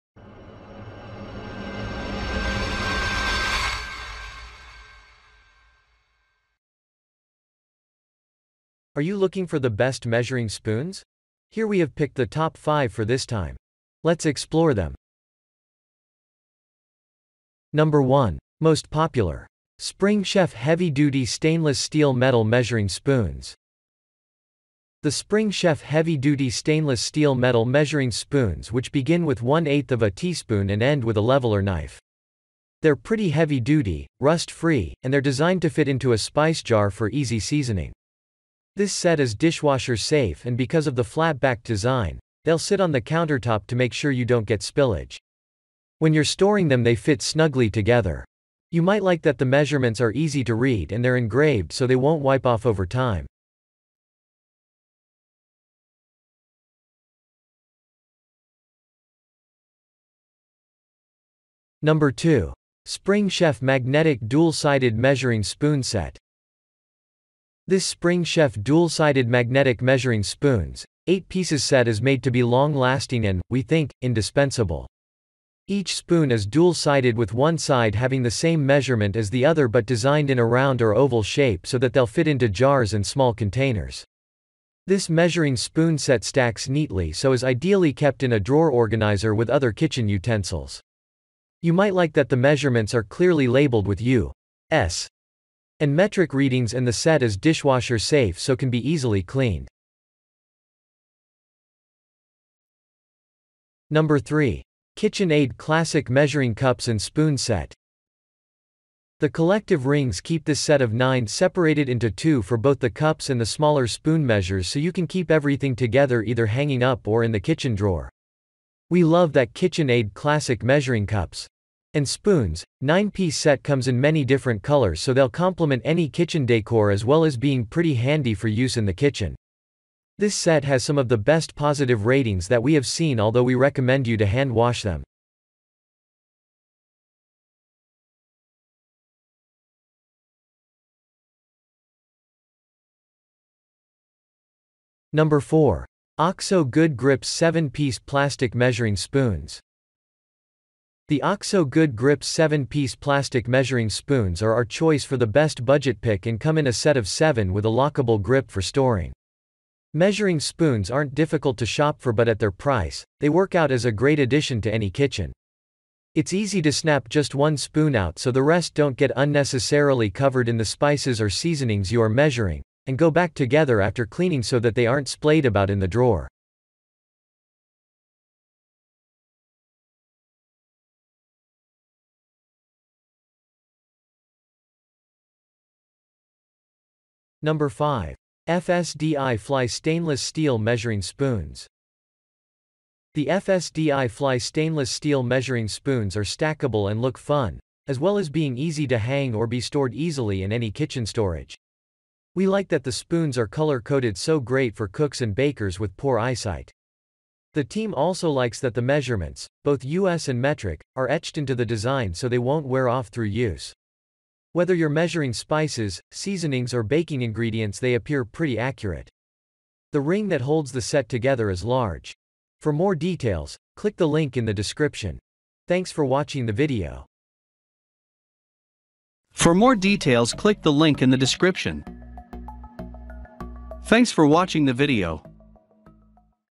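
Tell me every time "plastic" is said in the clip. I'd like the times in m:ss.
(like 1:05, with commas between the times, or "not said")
2:27, 2:32.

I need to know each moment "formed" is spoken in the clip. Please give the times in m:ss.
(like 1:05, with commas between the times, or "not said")
not said.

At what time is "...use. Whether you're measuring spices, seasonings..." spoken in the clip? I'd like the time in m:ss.
3:33.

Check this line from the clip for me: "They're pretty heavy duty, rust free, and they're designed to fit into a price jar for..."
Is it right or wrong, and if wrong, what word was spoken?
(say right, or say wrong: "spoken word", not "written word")
wrong: "spice", not "price".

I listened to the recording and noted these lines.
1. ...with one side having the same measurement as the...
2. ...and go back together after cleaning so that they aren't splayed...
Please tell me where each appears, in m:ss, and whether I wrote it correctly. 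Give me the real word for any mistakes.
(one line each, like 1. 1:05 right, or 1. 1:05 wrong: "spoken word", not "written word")
1. 1:17 right
2. 2:52 right.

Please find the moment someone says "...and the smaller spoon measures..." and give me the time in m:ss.
1:53.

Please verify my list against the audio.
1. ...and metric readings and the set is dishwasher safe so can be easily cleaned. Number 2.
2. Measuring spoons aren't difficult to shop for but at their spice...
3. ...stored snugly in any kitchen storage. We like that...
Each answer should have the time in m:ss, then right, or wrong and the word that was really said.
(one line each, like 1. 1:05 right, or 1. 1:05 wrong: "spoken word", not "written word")
1. 1:35 wrong: "3", not "2"
2. 2:39 wrong: "price", not "spice"
3. 3:19 wrong: "easily", not "snugly".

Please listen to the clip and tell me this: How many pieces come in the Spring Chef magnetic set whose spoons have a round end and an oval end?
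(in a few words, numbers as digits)
8.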